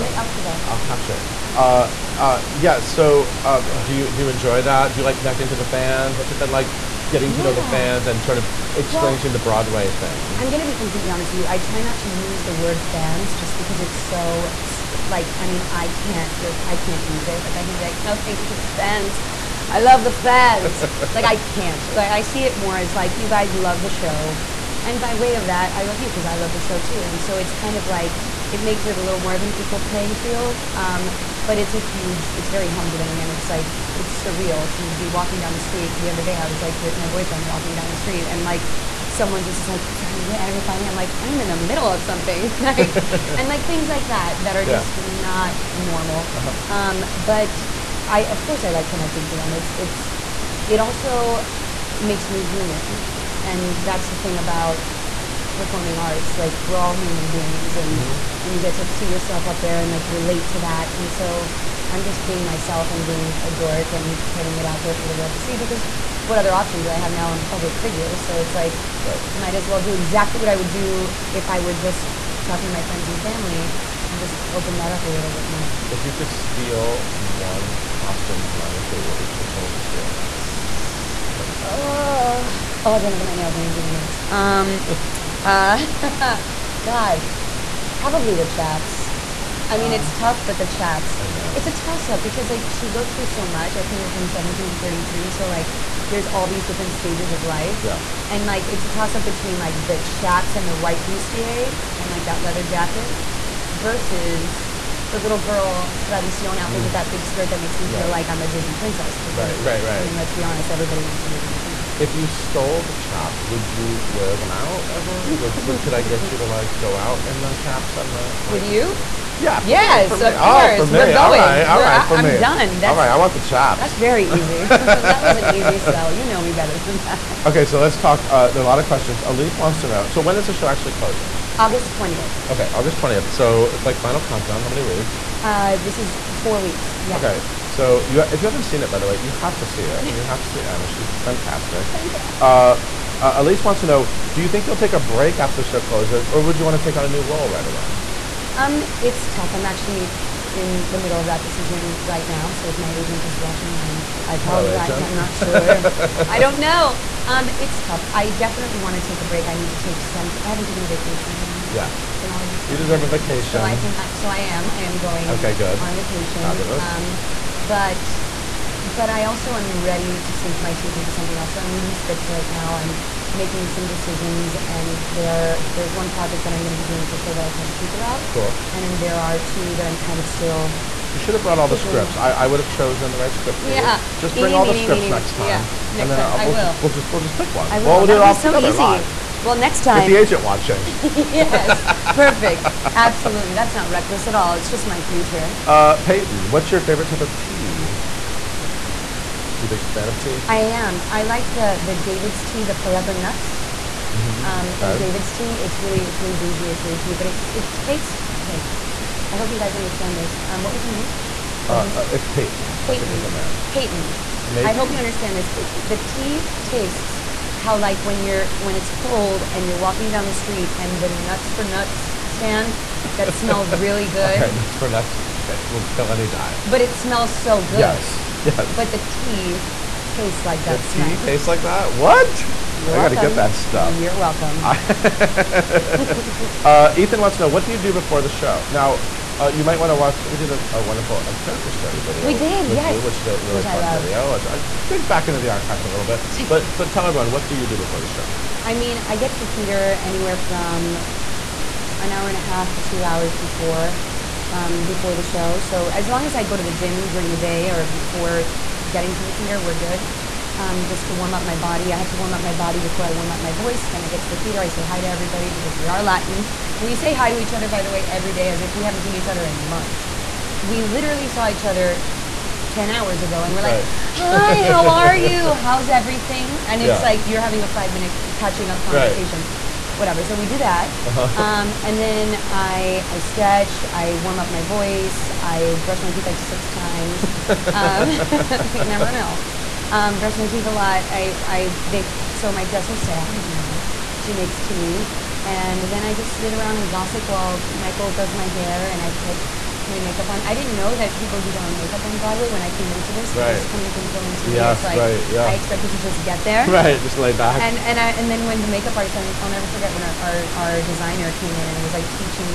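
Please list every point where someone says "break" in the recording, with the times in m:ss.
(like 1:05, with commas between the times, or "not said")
2:25, 2:39.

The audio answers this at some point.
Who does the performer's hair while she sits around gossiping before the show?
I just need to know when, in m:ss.
4:57.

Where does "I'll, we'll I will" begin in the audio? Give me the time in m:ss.
3:06.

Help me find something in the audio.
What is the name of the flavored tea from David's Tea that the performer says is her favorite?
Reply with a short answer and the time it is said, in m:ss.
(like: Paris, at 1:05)
Forever Nuts, at 3:22.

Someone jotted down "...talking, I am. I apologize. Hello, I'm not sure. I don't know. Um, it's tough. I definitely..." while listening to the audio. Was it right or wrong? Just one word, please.
wrong.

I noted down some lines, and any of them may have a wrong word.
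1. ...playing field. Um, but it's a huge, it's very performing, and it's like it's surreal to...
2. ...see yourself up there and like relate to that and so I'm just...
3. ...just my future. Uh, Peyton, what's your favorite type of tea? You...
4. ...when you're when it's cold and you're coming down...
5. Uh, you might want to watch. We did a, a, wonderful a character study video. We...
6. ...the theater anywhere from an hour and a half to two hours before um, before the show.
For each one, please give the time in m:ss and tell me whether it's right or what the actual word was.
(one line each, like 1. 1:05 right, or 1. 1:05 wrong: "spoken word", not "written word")
1. 0:29 wrong: "humbling", not "performing"
2. 0:58 right
3. 3:14 right
4. 3:38 wrong: "walking", not "coming"
5. 3:59 right
6. 4:09 right.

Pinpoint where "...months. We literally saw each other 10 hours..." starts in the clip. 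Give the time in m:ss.
4:29.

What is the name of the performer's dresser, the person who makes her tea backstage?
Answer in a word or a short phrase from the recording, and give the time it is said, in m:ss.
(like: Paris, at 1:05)
Sarah, at 4:52.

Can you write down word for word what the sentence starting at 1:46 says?
with that big skirt that makes me feel right.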